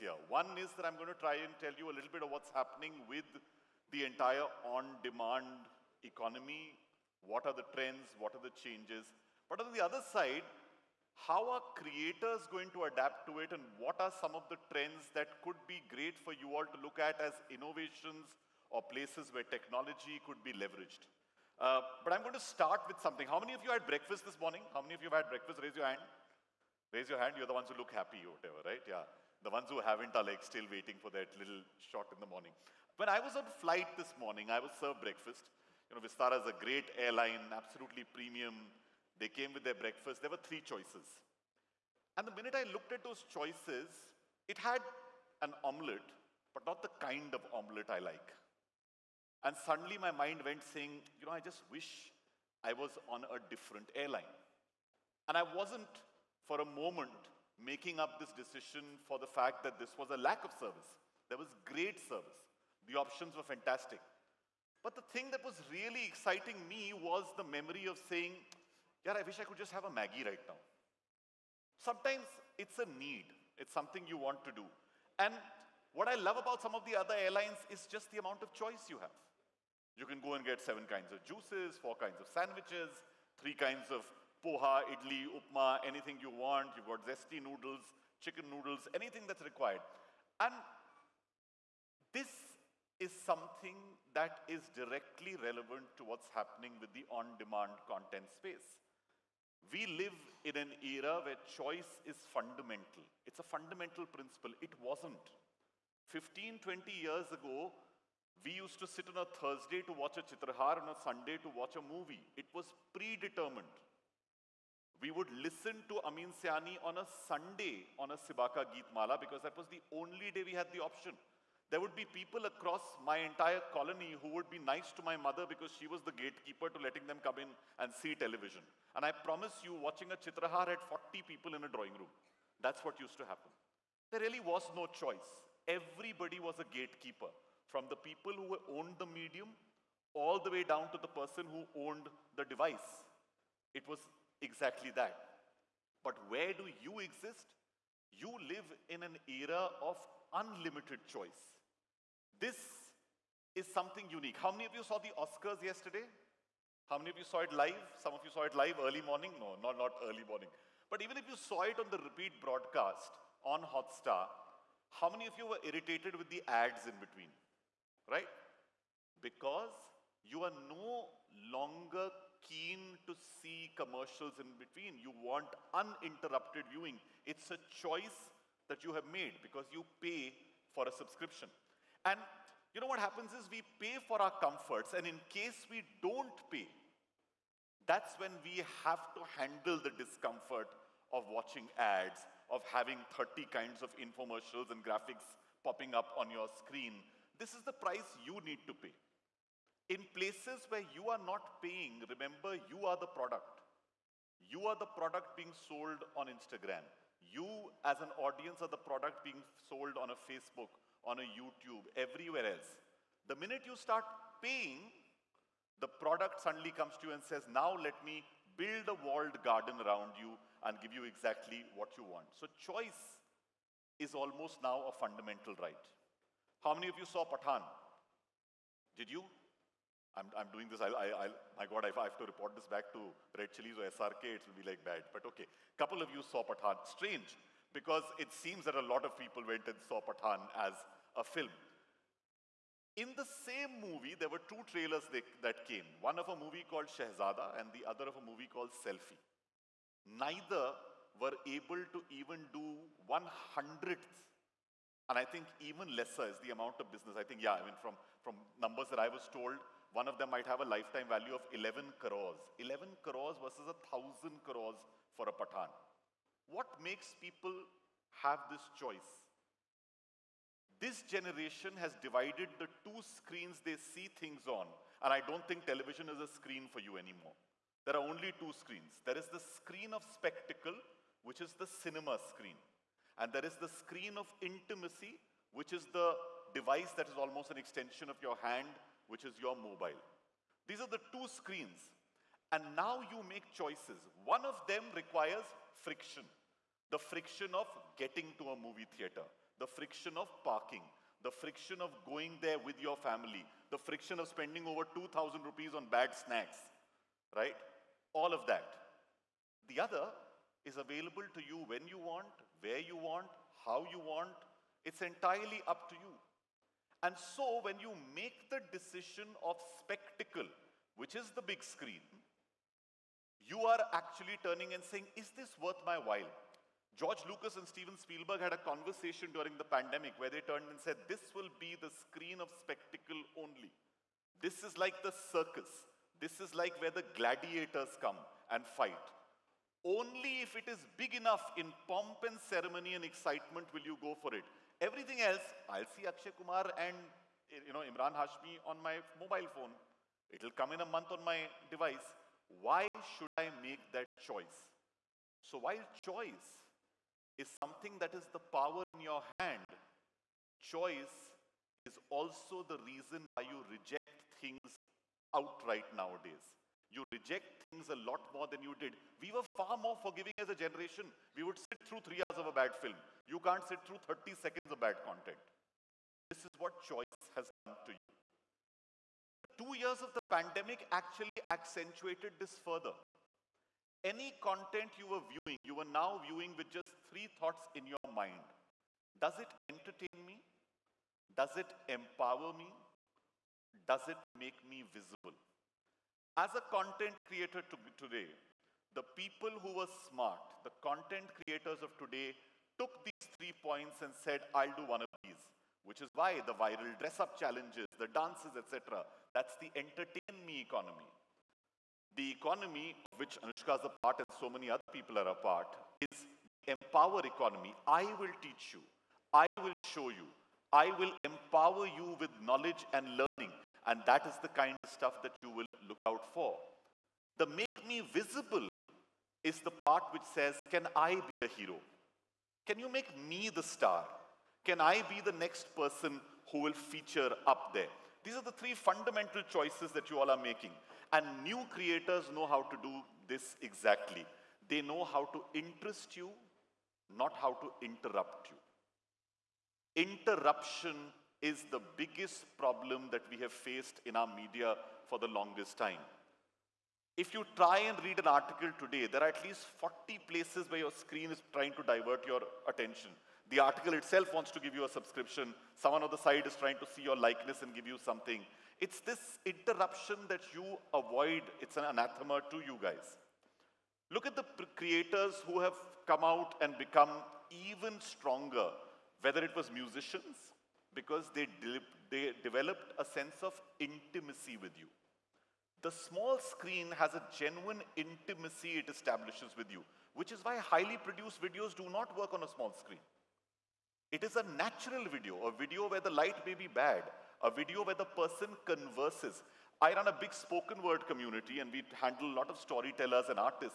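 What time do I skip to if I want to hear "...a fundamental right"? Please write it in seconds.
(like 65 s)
224 s.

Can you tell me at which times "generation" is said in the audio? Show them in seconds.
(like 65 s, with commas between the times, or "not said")
271 s, 370 s.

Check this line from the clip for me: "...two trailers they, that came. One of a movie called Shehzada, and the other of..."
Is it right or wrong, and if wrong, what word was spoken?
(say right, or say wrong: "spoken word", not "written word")
right.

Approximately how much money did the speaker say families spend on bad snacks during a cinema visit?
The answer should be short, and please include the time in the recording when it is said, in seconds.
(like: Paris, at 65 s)
2,000 rupees, at 304 s.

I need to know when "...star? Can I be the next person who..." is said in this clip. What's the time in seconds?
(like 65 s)
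433 s.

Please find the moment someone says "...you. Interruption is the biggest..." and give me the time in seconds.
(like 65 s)
449 s.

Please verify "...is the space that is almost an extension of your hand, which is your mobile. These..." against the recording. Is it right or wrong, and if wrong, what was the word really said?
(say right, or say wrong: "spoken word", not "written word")
wrong: "device", not "space".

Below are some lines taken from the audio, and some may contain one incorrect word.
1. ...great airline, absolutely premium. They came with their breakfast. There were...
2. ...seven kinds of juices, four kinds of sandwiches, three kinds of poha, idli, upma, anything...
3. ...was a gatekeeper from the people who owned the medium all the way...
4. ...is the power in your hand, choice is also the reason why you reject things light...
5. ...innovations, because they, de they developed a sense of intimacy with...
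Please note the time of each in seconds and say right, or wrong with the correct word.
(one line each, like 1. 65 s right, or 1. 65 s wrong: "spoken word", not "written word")
1. 36 s right
2. 80 s right
3. 136 s right
4. 358 s wrong: "outright", not "light"
5. 479 s wrong: "musicians", not "innovations".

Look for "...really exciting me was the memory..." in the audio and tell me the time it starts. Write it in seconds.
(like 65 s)
65 s.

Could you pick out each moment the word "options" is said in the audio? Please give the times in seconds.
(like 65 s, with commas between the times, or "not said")
62 s, 120 s.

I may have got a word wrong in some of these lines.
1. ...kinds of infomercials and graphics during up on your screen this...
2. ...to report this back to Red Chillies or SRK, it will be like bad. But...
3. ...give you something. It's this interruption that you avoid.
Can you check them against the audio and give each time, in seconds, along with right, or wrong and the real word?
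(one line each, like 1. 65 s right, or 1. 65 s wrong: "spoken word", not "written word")
1. 193 s wrong: "popping", not "during"
2. 232 s right
3. 467 s right.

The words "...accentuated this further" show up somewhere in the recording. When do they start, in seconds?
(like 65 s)
381 s.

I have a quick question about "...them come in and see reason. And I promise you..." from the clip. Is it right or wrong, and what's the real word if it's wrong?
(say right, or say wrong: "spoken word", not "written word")
wrong: "television", not "reason".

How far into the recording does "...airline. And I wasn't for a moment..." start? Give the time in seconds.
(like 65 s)
53 s.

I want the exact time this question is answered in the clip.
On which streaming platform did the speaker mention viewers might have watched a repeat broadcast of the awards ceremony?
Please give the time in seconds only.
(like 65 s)
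163 s.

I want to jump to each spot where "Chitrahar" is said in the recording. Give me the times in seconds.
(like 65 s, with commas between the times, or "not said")
110 s, 130 s.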